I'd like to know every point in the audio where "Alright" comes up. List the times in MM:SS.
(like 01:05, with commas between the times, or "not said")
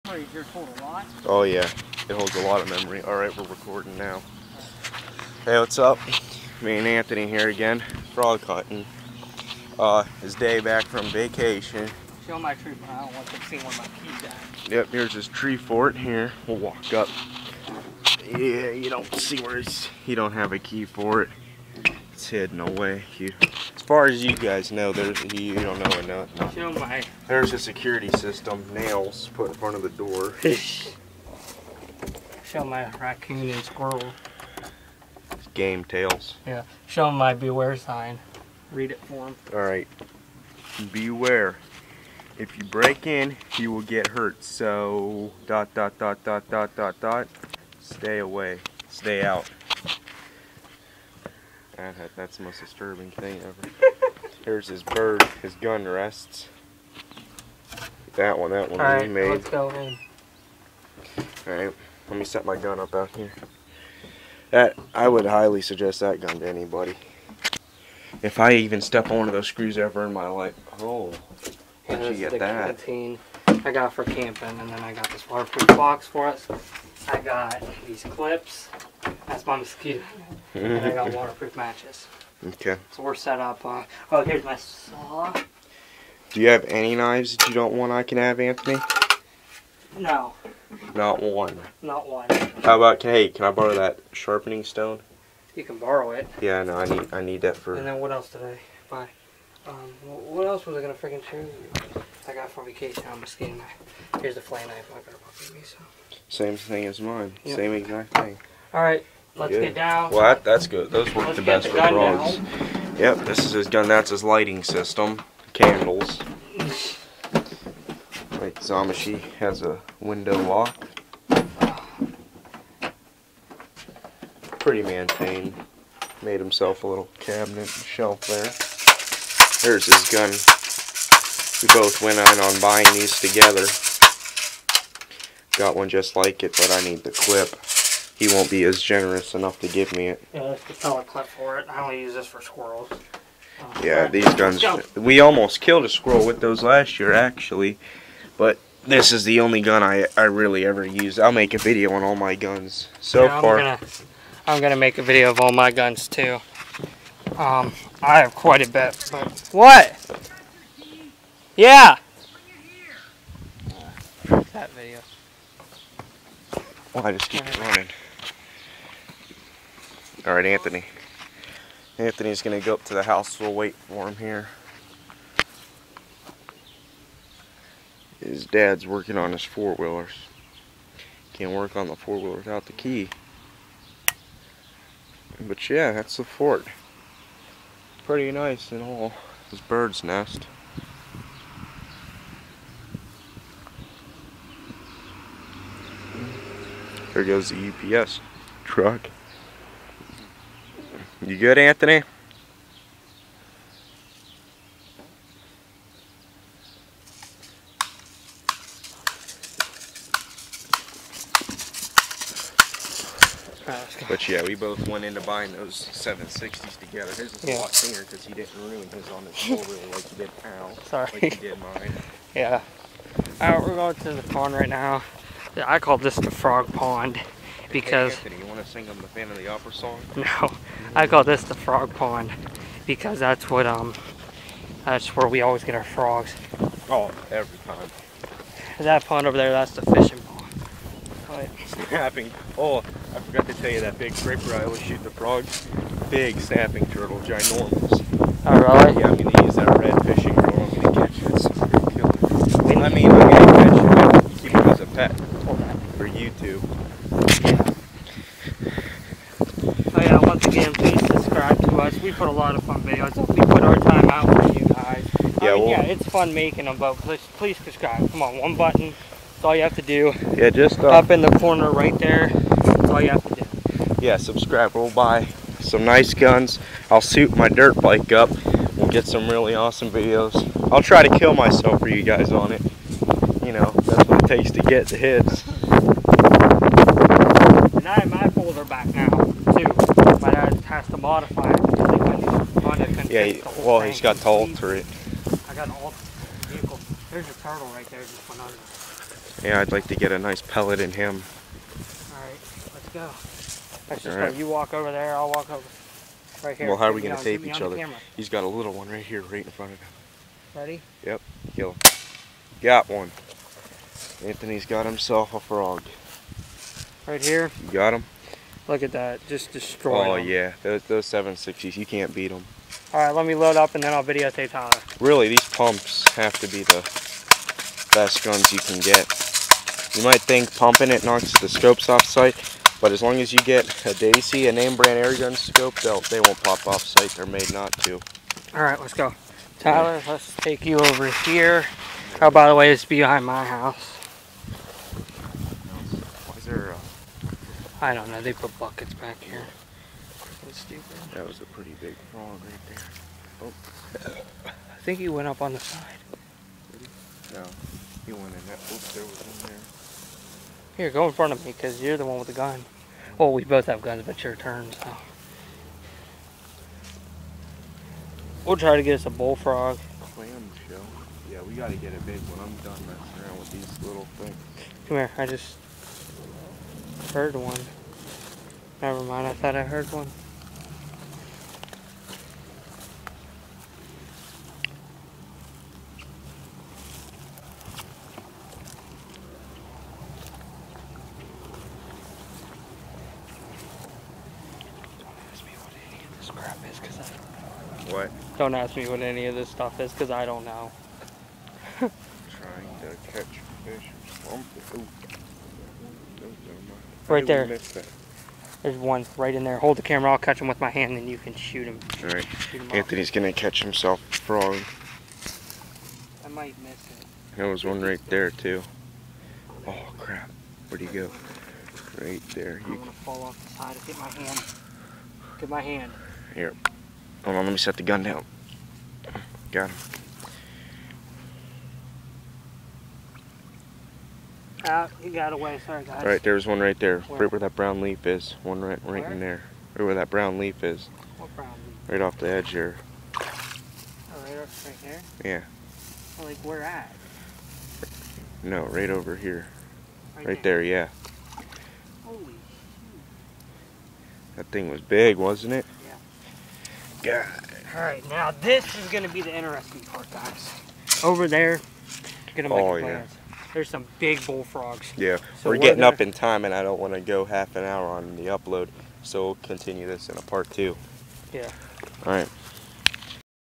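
01:01, 03:43, 05:02, 07:16, 07:37.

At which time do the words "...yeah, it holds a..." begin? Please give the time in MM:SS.
00:01.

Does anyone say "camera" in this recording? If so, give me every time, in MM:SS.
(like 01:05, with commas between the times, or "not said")
05:07, 06:49.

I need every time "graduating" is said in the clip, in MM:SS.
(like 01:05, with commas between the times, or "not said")
not said.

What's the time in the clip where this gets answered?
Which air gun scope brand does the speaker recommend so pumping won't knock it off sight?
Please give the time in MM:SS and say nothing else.
05:33.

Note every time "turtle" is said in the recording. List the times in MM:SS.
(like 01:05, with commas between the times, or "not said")
04:06, 04:57.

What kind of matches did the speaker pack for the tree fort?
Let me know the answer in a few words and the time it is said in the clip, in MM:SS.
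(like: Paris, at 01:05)
waterproof matches, at 01:21.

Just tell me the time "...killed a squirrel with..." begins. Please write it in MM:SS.
02:25.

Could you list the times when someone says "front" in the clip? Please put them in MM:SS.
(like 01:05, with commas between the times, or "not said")
00:29, 05:09, 06:01.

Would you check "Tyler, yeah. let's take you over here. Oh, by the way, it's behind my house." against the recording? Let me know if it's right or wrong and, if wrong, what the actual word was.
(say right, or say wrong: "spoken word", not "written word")
right.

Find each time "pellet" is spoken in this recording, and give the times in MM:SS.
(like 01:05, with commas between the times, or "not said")
02:20, 05:00.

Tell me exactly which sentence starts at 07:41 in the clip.
Over there, going to make oh, plans.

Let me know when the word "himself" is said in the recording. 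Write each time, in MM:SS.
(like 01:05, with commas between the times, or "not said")
02:06, 05:14, 06:53.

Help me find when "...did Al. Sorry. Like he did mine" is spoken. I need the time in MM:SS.
03:40.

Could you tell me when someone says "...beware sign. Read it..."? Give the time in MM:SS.
00:37.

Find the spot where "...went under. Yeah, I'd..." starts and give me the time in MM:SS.
04:58.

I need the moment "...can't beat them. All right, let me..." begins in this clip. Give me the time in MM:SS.
05:21.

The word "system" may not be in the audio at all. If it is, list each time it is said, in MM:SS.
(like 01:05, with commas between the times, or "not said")
00:28, 01:54.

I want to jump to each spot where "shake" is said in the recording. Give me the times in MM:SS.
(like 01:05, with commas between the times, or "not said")
not said.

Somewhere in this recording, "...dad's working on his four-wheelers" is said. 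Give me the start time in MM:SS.
02:58.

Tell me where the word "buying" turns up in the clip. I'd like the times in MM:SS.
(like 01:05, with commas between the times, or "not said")
02:12, 03:35.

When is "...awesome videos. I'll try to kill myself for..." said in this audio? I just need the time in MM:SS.
04:39.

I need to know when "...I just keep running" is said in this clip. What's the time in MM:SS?
02:47.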